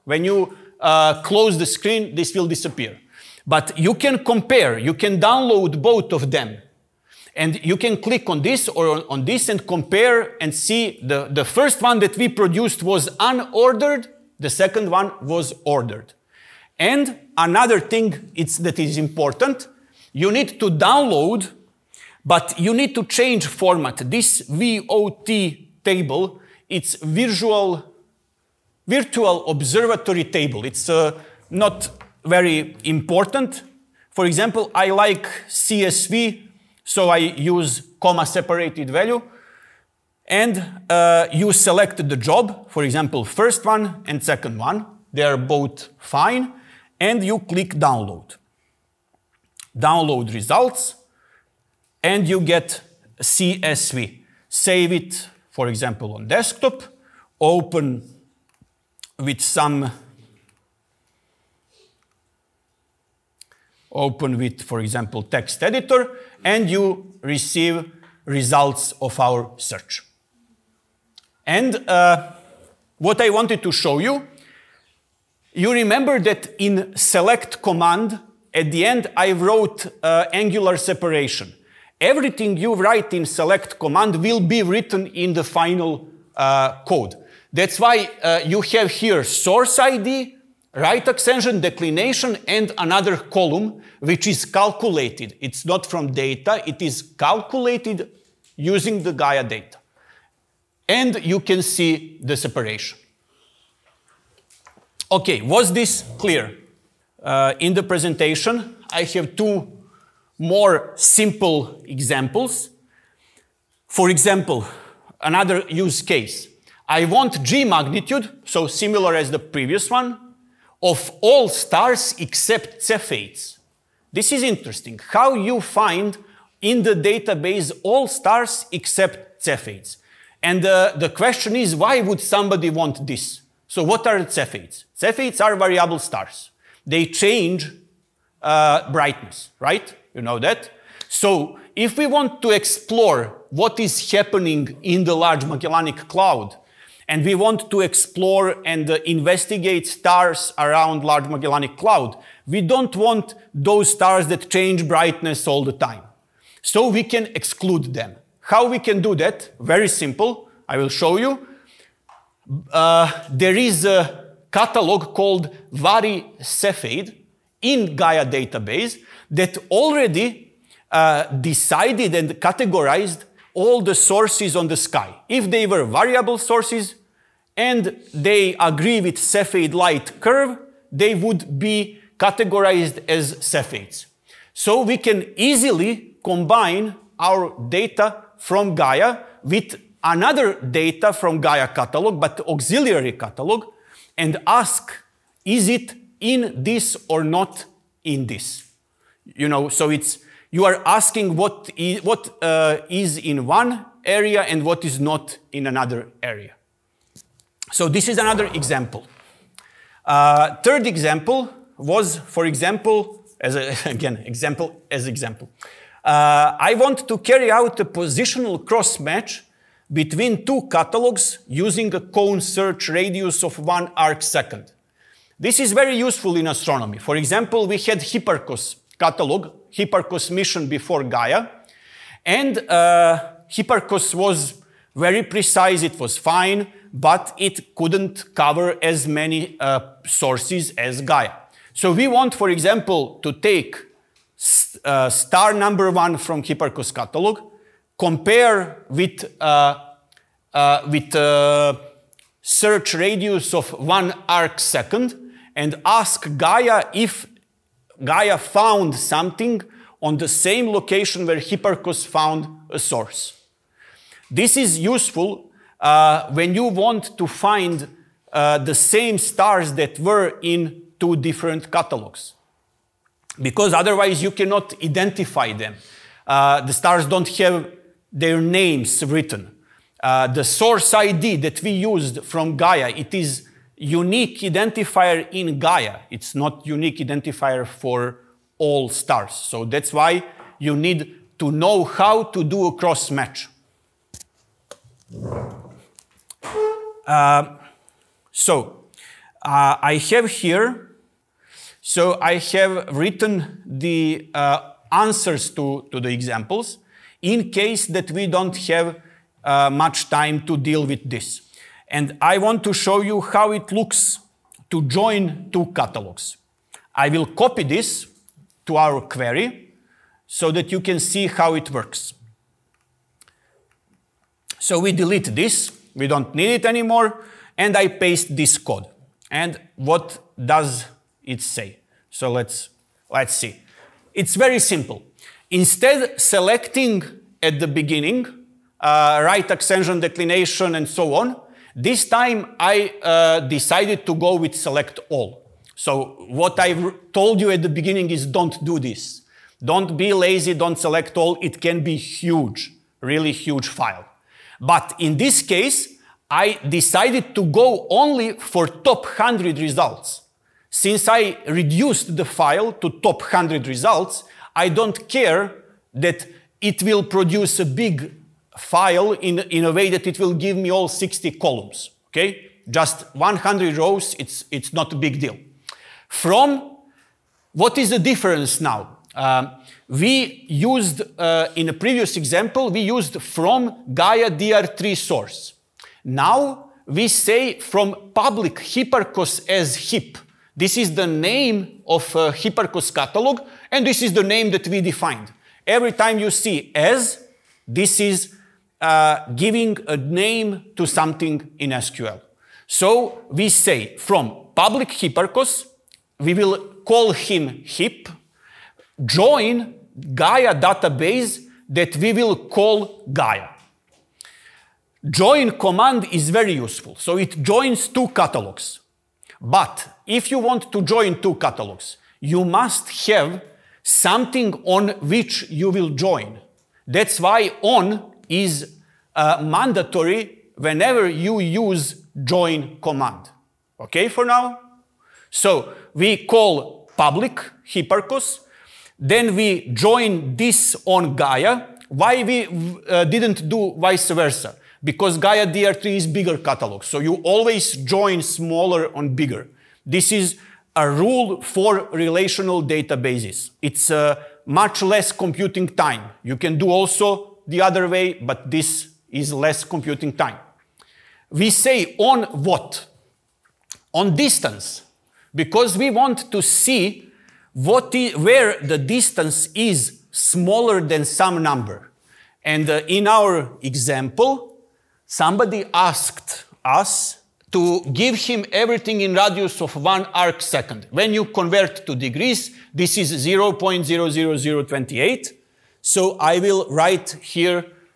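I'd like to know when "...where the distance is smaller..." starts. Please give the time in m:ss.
7:47.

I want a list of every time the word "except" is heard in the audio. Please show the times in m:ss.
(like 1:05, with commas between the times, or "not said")
2:02, 2:08.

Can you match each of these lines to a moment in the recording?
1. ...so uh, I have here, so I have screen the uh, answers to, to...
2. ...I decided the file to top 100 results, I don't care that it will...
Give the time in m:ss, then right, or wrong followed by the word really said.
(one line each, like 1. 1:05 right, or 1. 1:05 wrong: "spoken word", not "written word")
1. 4:58 wrong: "written", not "screen"
2. 6:01 wrong: "reduced", not "decided".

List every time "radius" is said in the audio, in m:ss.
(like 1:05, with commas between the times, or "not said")
3:42, 4:12, 7:59.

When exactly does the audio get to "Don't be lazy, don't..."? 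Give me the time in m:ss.
5:49.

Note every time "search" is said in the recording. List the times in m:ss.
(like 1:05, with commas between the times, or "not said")
1:09, 3:42, 4:12.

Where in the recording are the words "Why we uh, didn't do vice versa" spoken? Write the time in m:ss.
7:21.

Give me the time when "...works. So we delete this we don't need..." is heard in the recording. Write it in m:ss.
5:21.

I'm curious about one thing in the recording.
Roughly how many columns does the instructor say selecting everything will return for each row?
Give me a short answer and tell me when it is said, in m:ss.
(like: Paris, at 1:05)
60, at 6:10.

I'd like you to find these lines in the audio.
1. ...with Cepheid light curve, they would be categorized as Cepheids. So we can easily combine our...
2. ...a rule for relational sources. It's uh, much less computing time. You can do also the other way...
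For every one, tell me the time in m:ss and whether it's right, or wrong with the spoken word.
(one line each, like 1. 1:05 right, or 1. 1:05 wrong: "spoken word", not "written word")
1. 2:59 right
2. 7:30 wrong: "databases", not "sources".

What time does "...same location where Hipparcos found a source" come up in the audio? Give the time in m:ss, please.
4:20.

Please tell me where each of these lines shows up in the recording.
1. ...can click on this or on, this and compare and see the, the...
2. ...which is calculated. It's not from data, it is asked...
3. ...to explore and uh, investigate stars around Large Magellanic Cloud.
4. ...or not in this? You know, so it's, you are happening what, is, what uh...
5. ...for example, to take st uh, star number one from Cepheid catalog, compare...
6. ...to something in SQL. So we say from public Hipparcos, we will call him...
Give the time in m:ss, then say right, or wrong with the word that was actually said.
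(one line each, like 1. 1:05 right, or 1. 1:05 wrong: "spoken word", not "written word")
1. 0:07 right
2. 1:34 wrong: "calculated", not "asked"
3. 2:27 right
4. 3:17 wrong: "asking", not "happening"
5. 4:02 wrong: "Hipparcos", not "Cepheid"
6. 6:40 right.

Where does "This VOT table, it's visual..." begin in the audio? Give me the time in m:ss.
0:24.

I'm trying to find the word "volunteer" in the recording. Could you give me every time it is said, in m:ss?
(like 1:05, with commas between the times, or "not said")
not said.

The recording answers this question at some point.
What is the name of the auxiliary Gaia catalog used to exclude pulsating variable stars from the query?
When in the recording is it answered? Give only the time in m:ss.
2:45.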